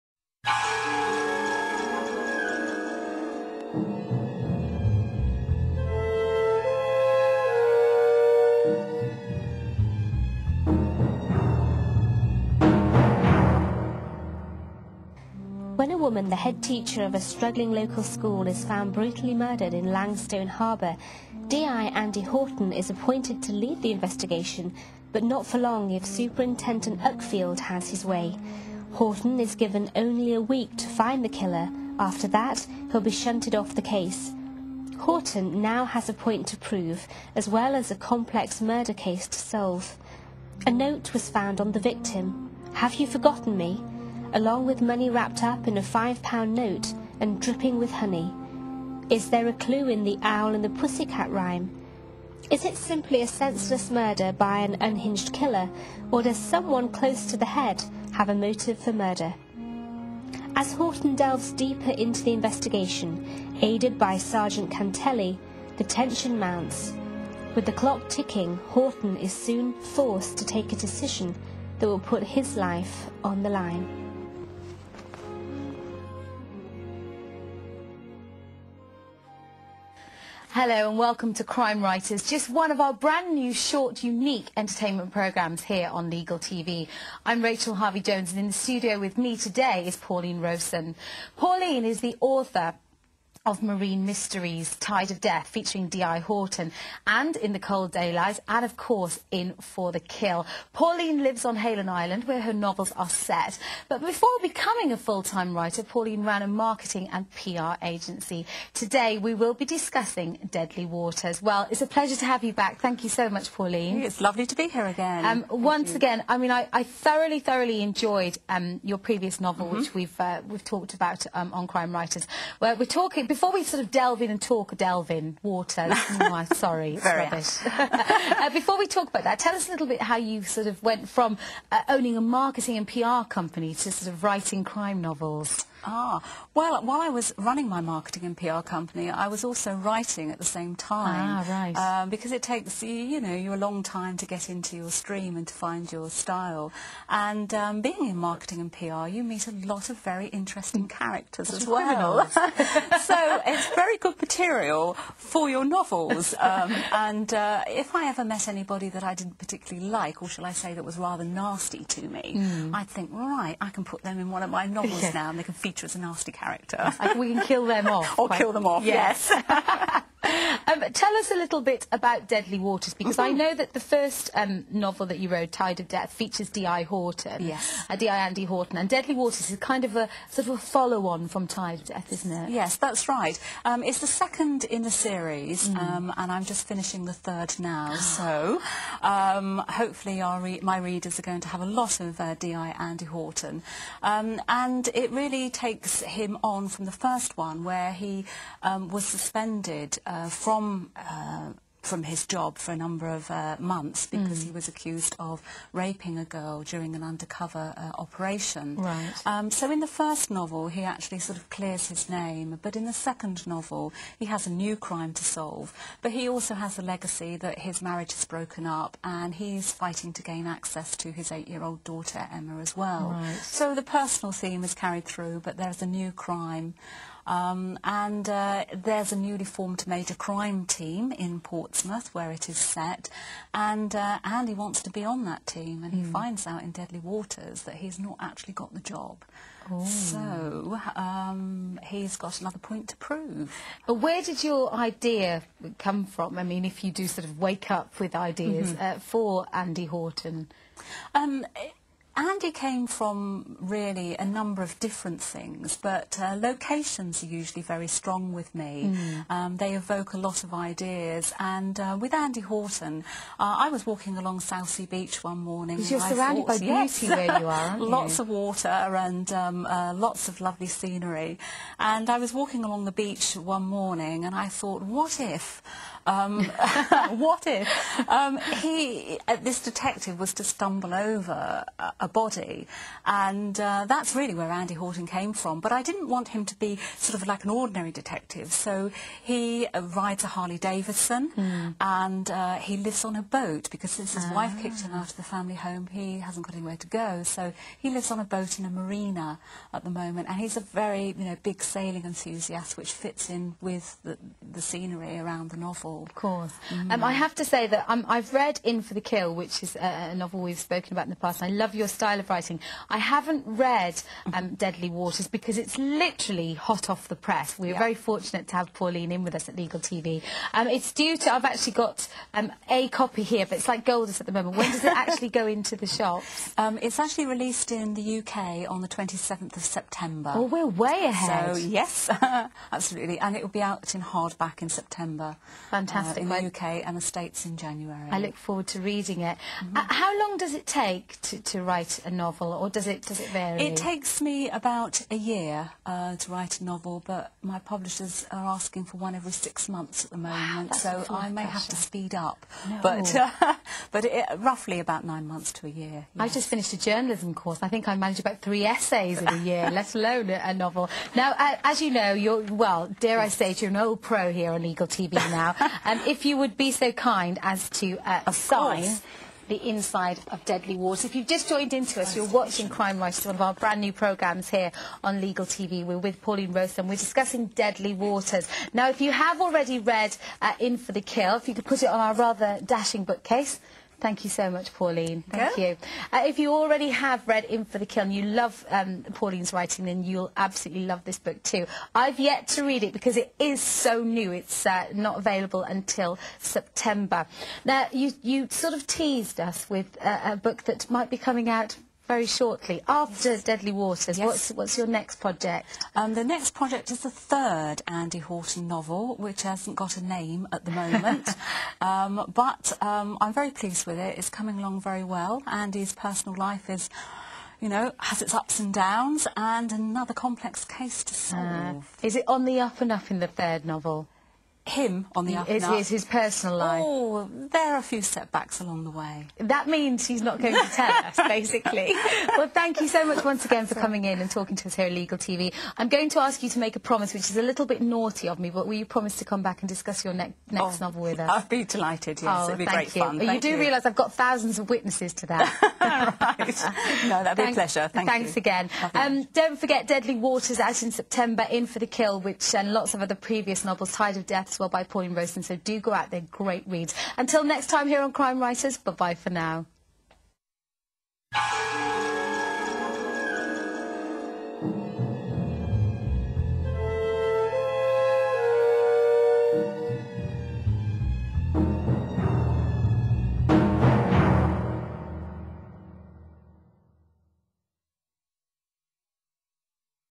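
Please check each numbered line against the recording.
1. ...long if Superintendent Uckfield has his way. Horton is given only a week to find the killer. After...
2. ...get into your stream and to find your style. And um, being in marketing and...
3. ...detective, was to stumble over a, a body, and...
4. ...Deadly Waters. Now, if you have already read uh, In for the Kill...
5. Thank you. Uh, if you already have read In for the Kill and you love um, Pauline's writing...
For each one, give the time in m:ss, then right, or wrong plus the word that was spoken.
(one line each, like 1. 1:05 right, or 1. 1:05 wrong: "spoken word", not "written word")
1. 0:25 right
2. 2:24 right
3. 4:39 right
4. 6:17 right
5. 6:25 right.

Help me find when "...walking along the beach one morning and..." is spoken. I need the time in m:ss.
4:32.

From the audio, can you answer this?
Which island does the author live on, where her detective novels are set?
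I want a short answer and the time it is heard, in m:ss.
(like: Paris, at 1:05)
Hayling Island, at 1:41.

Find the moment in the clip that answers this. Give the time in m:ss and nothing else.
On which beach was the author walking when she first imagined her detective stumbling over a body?
4:24.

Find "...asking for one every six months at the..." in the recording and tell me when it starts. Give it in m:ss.
5:48.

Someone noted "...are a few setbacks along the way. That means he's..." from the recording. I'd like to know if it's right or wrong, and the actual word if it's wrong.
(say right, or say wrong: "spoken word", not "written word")
right.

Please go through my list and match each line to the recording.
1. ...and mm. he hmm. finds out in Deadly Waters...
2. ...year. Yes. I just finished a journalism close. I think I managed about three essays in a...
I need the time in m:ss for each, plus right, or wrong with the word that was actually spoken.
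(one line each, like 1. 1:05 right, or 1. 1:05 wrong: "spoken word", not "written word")
1. 3:55 right
2. 5:55 wrong: "course", not "close".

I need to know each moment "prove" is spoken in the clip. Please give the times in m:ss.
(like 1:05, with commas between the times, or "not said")
0:36, 4:02.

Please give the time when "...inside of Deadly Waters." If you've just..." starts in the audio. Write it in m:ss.
6:09.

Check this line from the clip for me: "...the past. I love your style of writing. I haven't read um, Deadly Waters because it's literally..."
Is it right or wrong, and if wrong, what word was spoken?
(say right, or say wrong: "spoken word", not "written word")
right.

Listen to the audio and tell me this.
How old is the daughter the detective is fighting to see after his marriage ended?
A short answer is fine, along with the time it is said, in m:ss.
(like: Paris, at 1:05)
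8, at 3:41.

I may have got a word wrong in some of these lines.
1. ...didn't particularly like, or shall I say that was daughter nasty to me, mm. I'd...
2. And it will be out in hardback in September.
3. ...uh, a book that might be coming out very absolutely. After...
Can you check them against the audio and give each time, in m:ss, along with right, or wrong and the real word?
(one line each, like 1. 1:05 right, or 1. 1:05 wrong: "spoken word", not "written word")
1. 2:39 wrong: "rather", not "daughter"
2. 5:33 right
3. 6:40 wrong: "shortly", not "absolutely".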